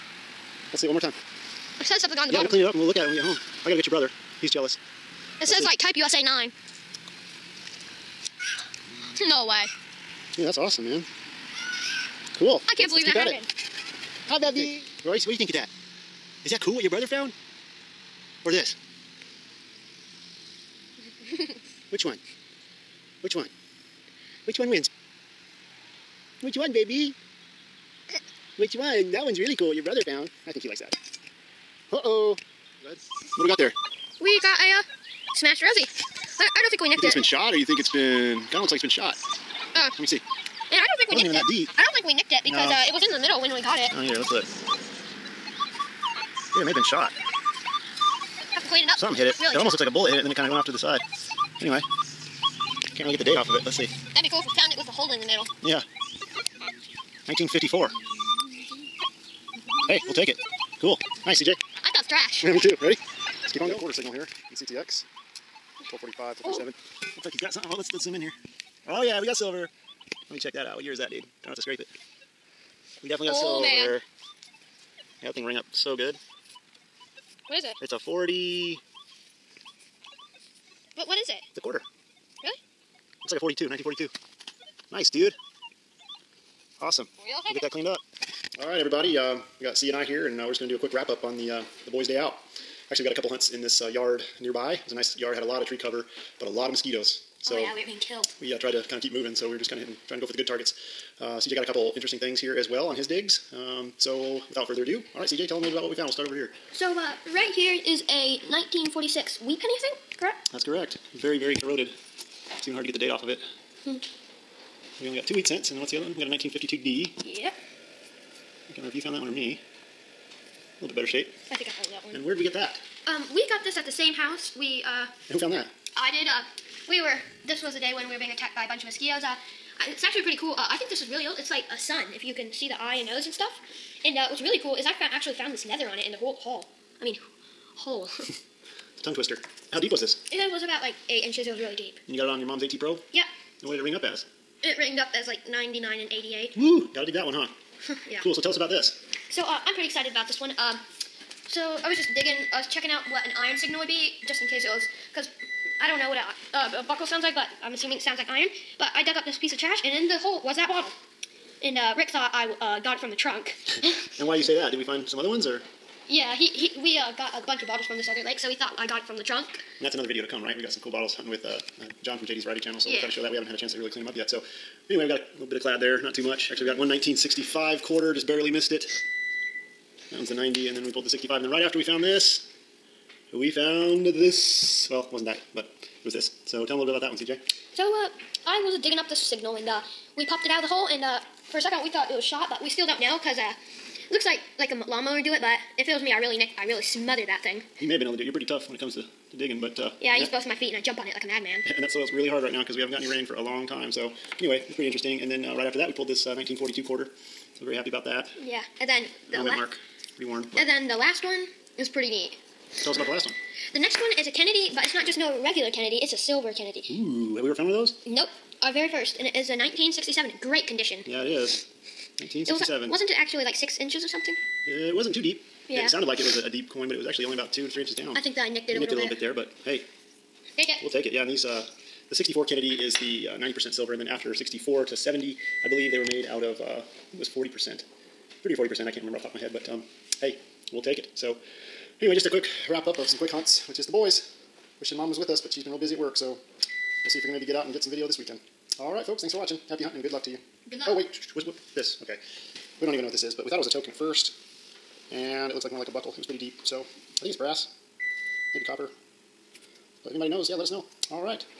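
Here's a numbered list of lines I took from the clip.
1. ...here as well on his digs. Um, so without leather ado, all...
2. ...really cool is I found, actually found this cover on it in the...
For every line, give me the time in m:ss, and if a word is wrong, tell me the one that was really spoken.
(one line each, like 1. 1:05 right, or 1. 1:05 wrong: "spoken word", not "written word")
1. 1:42 wrong: "further", not "leather"
2. 2:14 wrong: "leather", not "cover".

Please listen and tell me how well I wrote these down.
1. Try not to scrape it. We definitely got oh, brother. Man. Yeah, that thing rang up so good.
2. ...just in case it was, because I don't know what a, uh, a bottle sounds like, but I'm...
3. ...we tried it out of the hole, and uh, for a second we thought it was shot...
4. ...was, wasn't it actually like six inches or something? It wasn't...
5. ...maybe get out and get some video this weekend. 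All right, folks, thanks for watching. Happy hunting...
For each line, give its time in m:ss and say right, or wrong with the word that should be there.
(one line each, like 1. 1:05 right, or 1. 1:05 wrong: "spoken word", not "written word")
1. 1:11 wrong: "silver", not "brother"
2. 2:34 wrong: "buckle", not "bottle"
3. 3:10 wrong: "popped", not "tried"
4. 3:42 right
5. 4:07 right.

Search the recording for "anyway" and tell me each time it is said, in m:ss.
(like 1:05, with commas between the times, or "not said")
0:51, 2:54, 3:24, 4:02.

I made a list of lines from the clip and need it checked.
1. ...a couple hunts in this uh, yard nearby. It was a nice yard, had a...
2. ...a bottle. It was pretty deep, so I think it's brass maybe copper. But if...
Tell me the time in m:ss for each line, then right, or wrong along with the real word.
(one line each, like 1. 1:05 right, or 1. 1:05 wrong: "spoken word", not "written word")
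1. 1:33 right
2. 4:15 wrong: "buckle", not "bottle".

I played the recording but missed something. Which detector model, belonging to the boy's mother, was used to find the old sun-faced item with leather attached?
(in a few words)
AT Pro.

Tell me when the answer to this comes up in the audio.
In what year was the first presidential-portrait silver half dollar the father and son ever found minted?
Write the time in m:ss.
3:39.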